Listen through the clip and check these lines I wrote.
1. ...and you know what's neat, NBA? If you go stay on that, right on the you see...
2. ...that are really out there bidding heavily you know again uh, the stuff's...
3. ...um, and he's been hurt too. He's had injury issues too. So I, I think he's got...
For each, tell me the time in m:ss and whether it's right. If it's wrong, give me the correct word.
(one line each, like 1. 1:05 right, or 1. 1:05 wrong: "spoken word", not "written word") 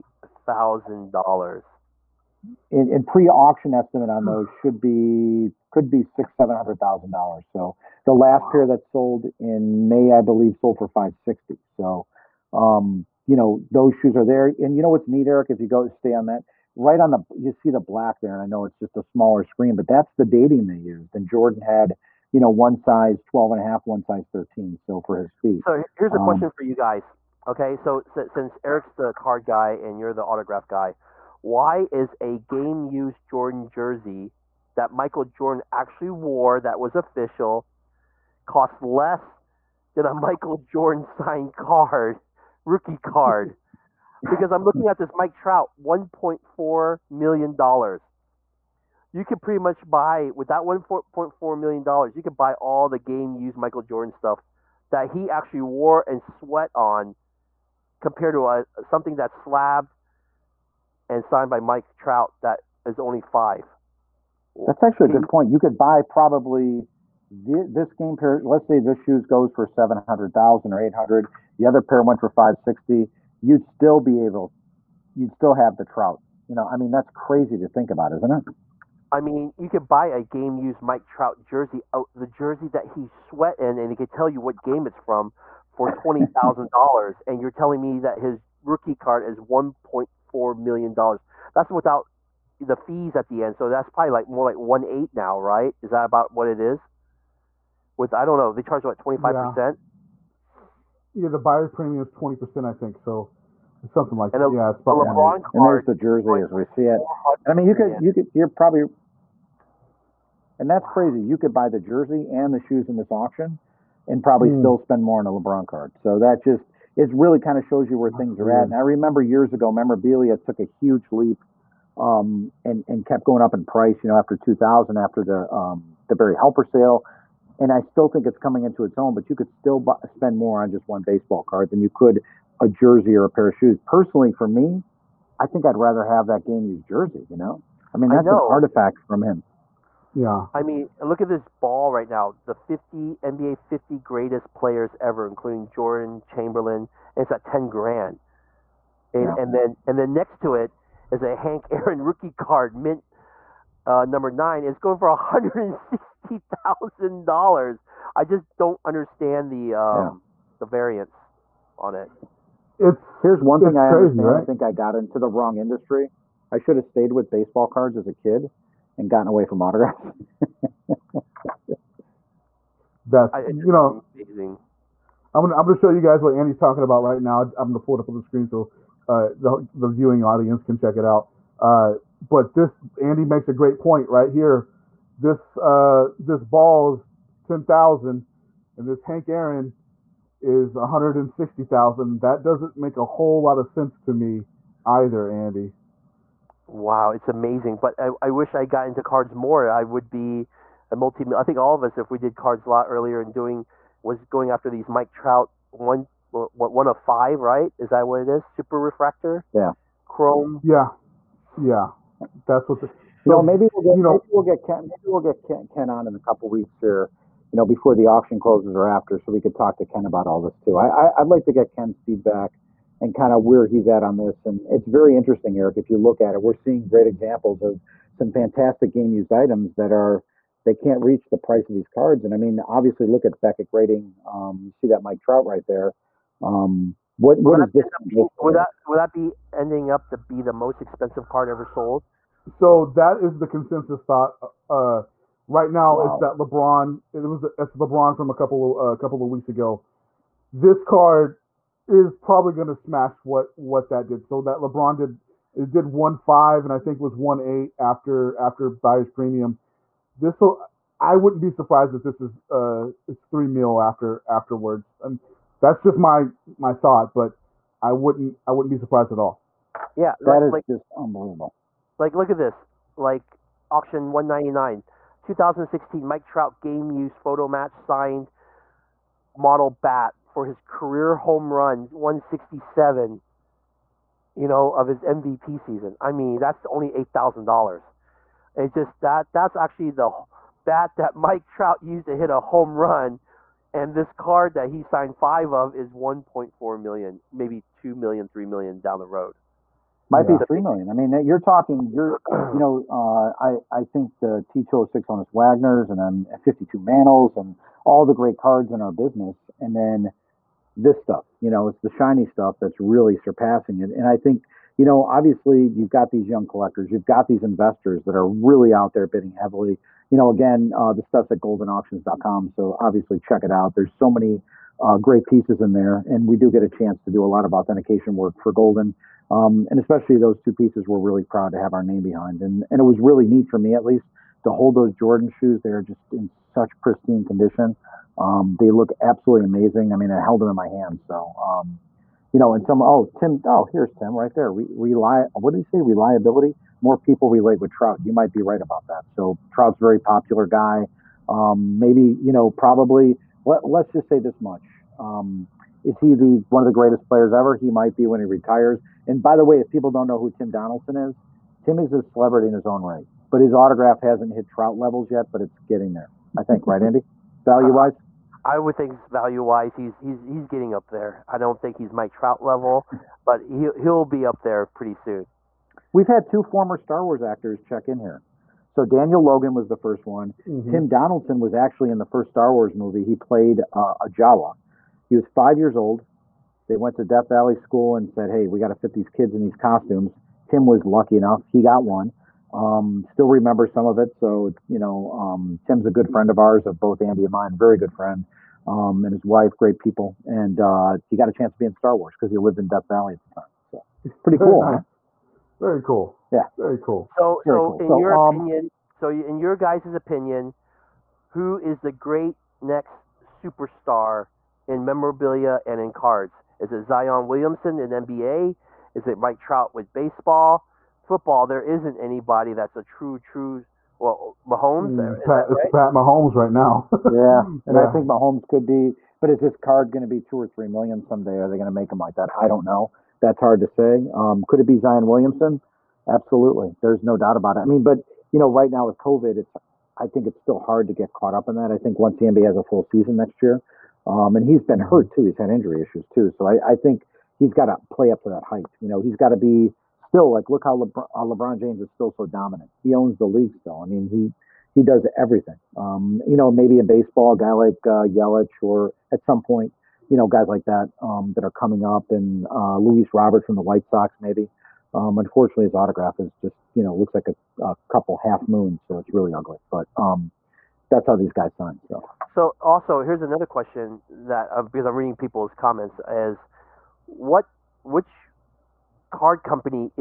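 1. 0:14 wrong: "Eric", not "NBA"
2. 5:18 right
3. 7:24 right.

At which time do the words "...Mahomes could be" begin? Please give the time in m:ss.
7:08.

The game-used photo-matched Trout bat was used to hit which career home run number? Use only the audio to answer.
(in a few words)
167.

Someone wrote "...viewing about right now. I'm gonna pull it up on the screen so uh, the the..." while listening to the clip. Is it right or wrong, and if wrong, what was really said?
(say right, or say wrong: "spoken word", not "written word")
wrong: "talking", not "viewing".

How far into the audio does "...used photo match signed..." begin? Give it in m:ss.
4:36.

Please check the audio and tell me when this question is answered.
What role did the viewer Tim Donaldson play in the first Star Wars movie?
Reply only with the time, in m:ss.
6:24.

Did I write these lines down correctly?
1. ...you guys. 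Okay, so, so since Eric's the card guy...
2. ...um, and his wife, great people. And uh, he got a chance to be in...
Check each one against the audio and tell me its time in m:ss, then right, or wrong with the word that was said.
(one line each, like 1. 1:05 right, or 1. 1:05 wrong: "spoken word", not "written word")
1. 0:26 right
2. 6:38 right.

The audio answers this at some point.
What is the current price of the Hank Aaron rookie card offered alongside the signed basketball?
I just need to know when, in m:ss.
2:35.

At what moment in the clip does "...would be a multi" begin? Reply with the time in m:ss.
3:19.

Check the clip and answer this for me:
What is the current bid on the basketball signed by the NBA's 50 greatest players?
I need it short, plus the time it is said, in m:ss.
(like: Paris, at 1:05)
10 grand, at 2:27.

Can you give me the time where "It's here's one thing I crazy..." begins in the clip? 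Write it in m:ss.
2:42.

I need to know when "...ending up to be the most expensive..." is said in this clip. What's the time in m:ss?
3:59.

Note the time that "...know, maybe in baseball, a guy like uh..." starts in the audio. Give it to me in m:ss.
7:36.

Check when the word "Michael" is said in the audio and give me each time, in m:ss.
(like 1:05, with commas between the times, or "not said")
0:34, 0:40, 0:53.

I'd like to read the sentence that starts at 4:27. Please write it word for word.
But I wouldn't I wouldn't be surprised at all.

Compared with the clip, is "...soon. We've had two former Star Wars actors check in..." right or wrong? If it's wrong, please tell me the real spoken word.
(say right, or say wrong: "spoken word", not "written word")
right.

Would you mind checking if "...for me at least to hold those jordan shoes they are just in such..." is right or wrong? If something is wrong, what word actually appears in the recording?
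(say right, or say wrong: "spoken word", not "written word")
right.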